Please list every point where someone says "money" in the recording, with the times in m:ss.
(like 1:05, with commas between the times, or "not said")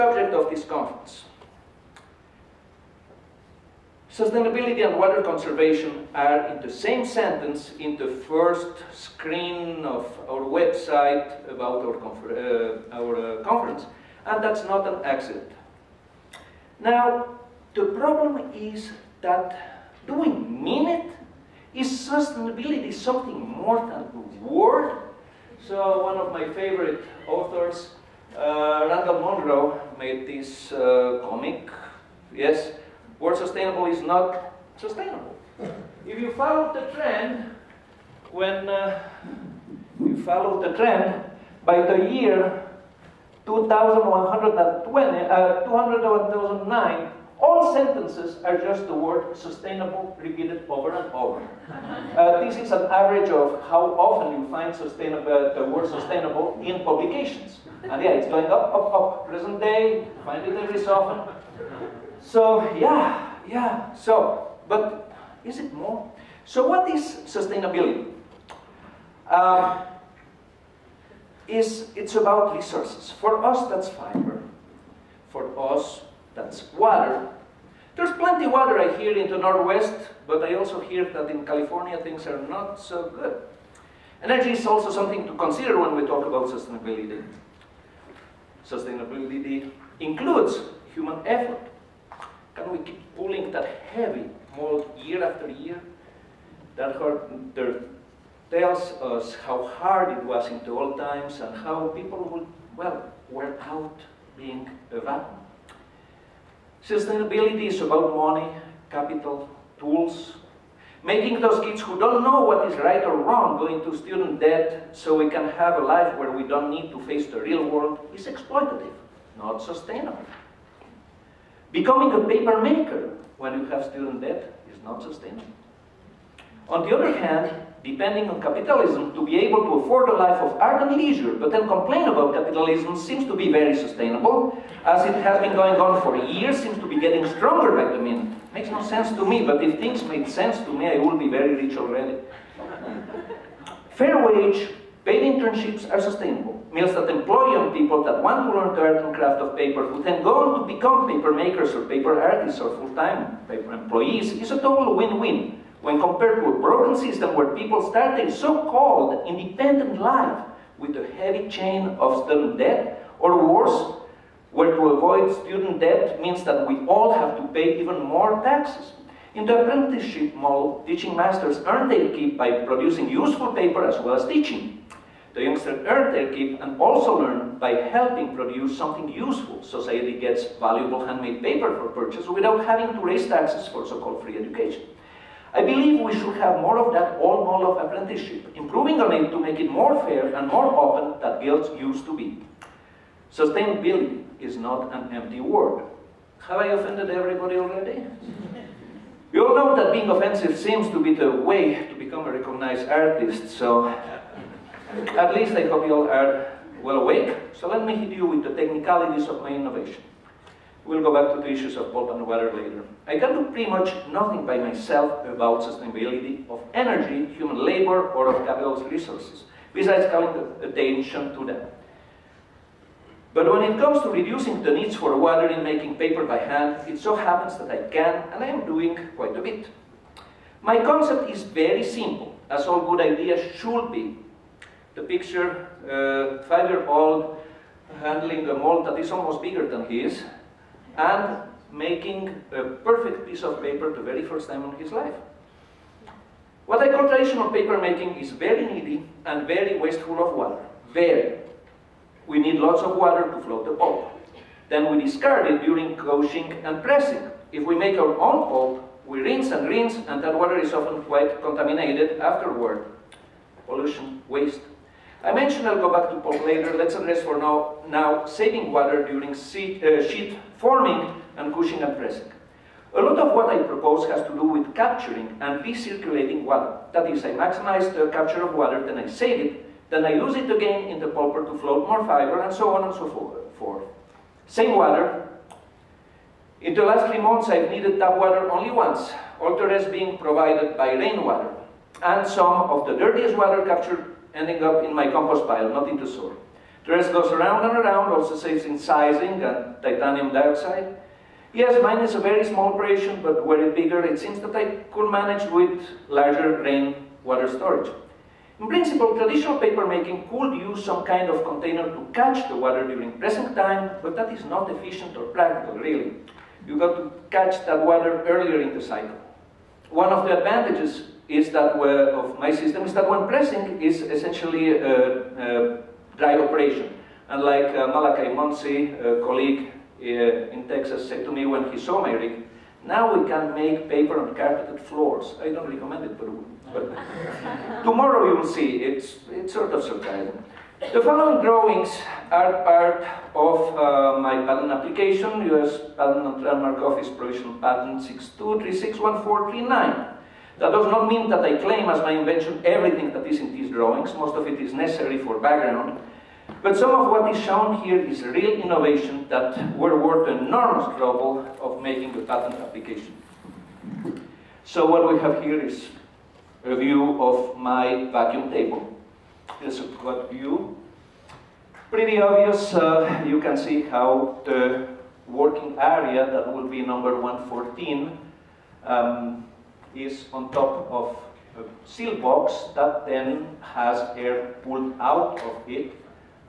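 1:48.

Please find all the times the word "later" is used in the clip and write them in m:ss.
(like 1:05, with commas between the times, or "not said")
3:32, 4:26.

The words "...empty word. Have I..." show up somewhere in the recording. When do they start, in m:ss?
3:15.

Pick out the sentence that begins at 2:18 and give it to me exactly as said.
Makes no sense to me, but if things made sense to me, I would be very rich already.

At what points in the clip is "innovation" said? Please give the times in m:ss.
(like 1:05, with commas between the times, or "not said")
3:29, 5:58.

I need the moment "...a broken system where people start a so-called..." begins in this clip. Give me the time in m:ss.
2:36.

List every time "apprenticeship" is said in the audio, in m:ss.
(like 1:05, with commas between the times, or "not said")
2:49, 3:07.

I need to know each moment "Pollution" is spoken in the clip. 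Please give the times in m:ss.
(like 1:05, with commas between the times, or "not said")
4:23.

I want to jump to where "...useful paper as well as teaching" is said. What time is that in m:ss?
2:53.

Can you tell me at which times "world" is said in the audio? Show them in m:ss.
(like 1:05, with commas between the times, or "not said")
1:57.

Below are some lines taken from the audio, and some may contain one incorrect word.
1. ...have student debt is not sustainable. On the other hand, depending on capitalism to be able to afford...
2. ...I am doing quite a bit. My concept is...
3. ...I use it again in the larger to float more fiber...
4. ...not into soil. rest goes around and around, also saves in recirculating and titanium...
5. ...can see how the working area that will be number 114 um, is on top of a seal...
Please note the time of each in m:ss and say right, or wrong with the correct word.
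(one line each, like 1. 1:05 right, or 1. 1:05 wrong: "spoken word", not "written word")
1. 2:03 right
2. 3:48 right
3. 4:40 wrong: "pulper", not "larger"
4. 4:55 wrong: "sizing", not "recirculating"
5. 6:13 right.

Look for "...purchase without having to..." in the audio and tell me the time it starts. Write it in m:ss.
3:01.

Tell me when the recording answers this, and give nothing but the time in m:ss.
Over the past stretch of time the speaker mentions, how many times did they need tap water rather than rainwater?
4:48.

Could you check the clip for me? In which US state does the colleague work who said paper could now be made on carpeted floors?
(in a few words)
Texas.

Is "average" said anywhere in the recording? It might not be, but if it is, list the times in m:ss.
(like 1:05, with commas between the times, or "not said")
0:52.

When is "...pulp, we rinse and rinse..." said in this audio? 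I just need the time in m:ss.
4:18.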